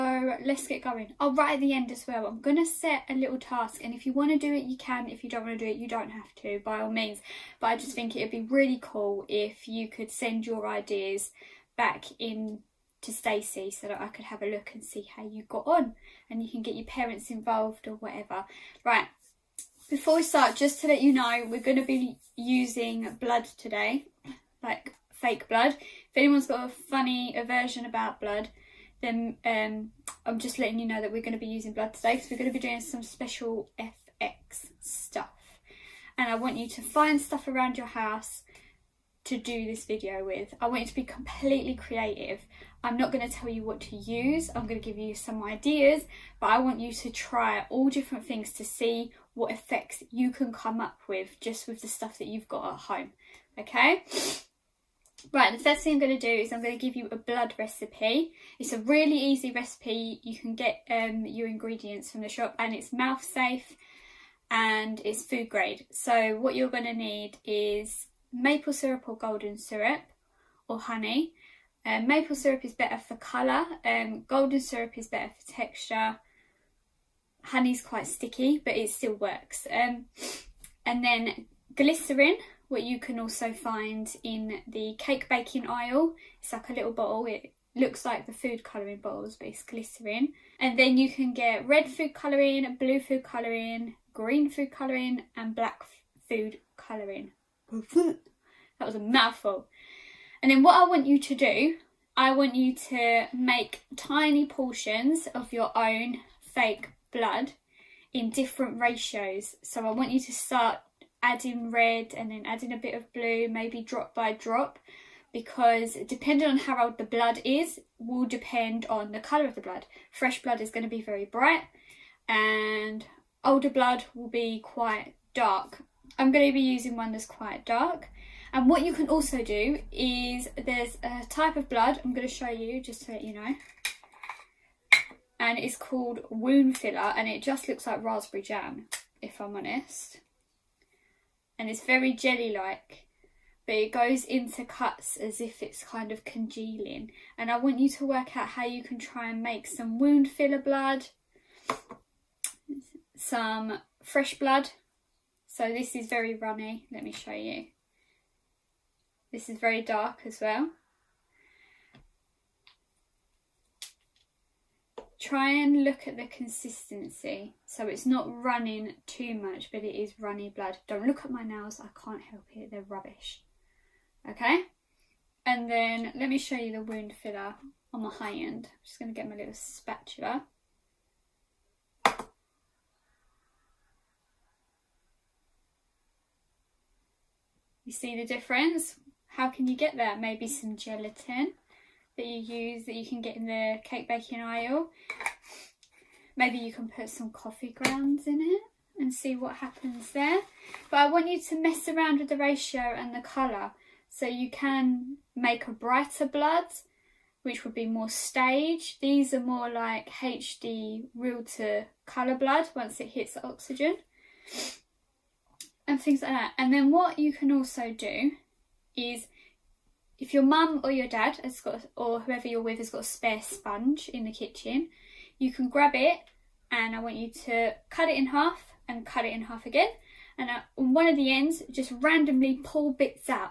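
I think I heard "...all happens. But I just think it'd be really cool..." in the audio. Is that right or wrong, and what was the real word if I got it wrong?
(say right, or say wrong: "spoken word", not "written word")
wrong: "means", not "happens".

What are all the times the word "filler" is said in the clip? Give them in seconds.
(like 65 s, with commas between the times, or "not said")
136 s, 150 s, 177 s.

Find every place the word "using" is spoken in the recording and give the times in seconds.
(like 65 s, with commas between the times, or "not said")
22 s, 31 s, 126 s.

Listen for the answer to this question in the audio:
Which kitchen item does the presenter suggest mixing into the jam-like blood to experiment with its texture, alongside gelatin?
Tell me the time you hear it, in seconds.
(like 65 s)
197 s.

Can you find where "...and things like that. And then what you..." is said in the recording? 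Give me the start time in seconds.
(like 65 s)
215 s.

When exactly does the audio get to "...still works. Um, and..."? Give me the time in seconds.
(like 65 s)
78 s.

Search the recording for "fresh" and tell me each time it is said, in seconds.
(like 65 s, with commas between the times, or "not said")
120 s, 154 s.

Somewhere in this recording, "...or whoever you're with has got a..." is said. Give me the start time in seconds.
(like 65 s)
221 s.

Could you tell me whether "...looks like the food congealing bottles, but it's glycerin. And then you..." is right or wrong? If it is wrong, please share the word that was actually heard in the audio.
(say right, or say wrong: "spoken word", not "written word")
wrong: "colouring", not "congealing".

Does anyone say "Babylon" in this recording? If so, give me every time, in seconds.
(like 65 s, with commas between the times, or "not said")
not said.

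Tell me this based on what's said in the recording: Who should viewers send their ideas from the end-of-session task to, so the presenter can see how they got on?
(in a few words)
Stacey.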